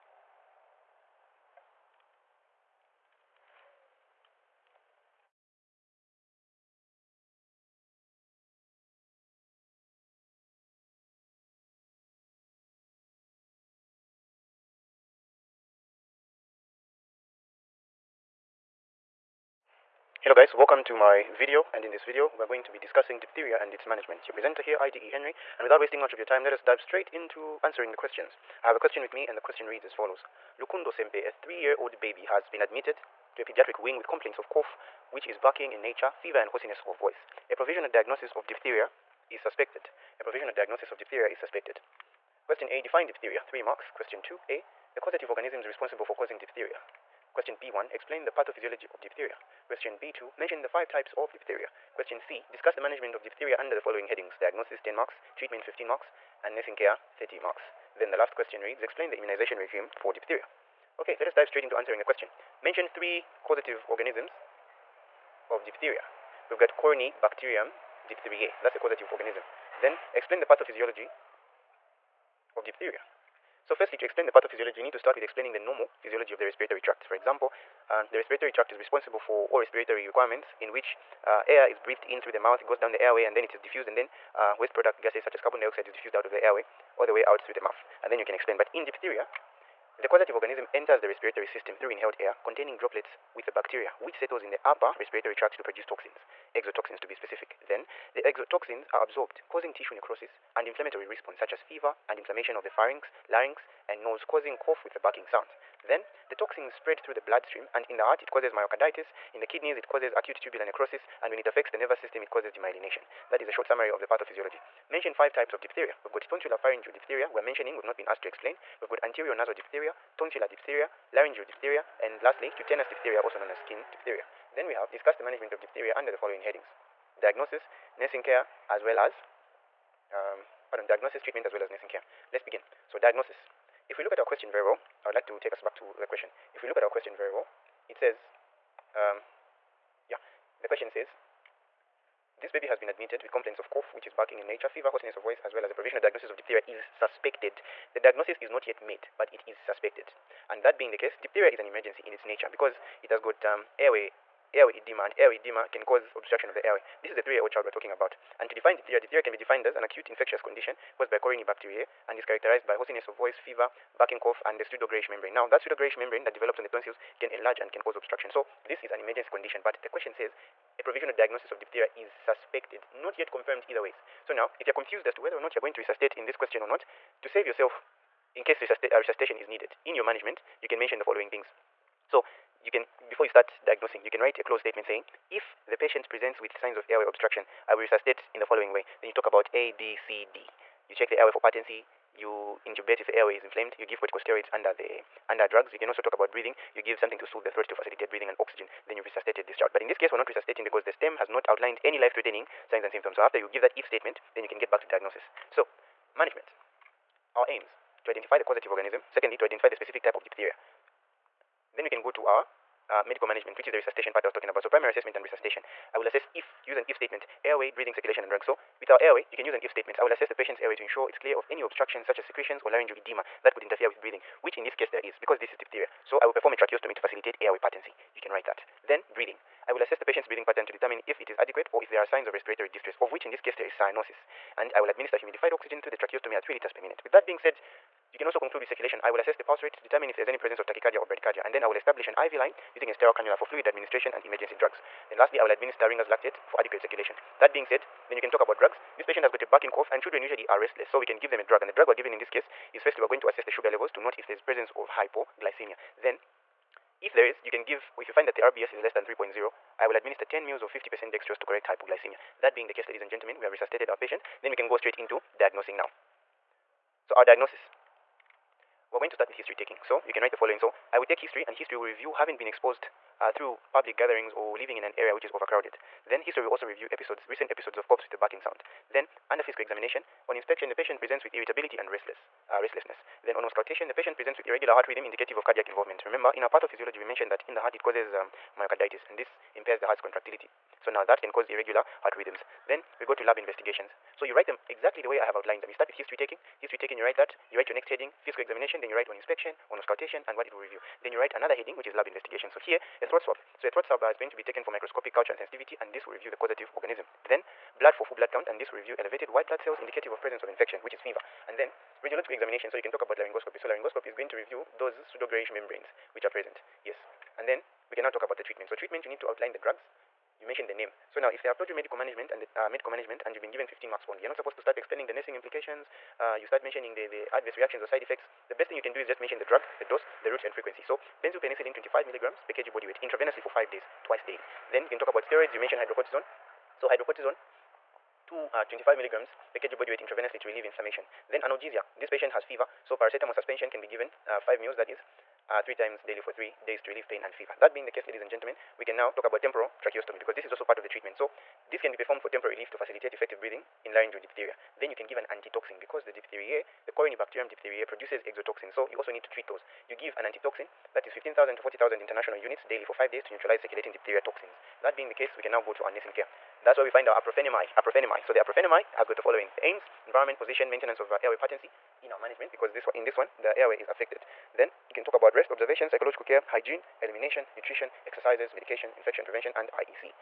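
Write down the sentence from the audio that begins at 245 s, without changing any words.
Then lastly, I will administer Ringer's lactate for adequate circulation.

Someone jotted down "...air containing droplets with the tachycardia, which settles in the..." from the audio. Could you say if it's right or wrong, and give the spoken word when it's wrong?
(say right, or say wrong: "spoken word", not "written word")
wrong: "bacteria", not "tachycardia".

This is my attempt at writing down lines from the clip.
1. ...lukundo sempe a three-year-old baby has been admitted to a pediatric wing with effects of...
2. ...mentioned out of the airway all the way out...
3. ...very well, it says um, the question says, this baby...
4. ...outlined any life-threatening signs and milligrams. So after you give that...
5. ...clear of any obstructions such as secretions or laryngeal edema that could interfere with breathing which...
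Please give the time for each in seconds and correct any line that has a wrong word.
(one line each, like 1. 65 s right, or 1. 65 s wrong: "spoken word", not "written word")
1. 30 s wrong: "complaints", not "effects"
2. 85 s wrong: "diffused", not "mentioned"
3. 137 s right
4. 201 s wrong: "symptoms", not "milligrams"
5. 221 s right.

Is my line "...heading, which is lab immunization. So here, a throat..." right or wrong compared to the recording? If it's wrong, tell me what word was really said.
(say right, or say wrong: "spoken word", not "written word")
wrong: "investigation", not "immunization".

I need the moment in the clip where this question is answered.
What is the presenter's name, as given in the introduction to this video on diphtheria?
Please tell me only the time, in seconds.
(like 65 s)
24 s.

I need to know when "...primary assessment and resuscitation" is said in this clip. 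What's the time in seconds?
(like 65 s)
214 s.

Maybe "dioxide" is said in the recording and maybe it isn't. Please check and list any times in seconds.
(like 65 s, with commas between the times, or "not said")
85 s.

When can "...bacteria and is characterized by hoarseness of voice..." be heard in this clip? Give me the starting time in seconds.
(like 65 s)
161 s.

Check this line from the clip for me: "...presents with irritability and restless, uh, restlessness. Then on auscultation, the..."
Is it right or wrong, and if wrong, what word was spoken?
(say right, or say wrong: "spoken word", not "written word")
right.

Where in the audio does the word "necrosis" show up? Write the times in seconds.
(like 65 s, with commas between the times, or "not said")
99 s, 110 s.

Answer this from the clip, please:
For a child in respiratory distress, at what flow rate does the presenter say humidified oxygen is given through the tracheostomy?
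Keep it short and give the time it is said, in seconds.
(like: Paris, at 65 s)
3 liters per minute, at 236 s.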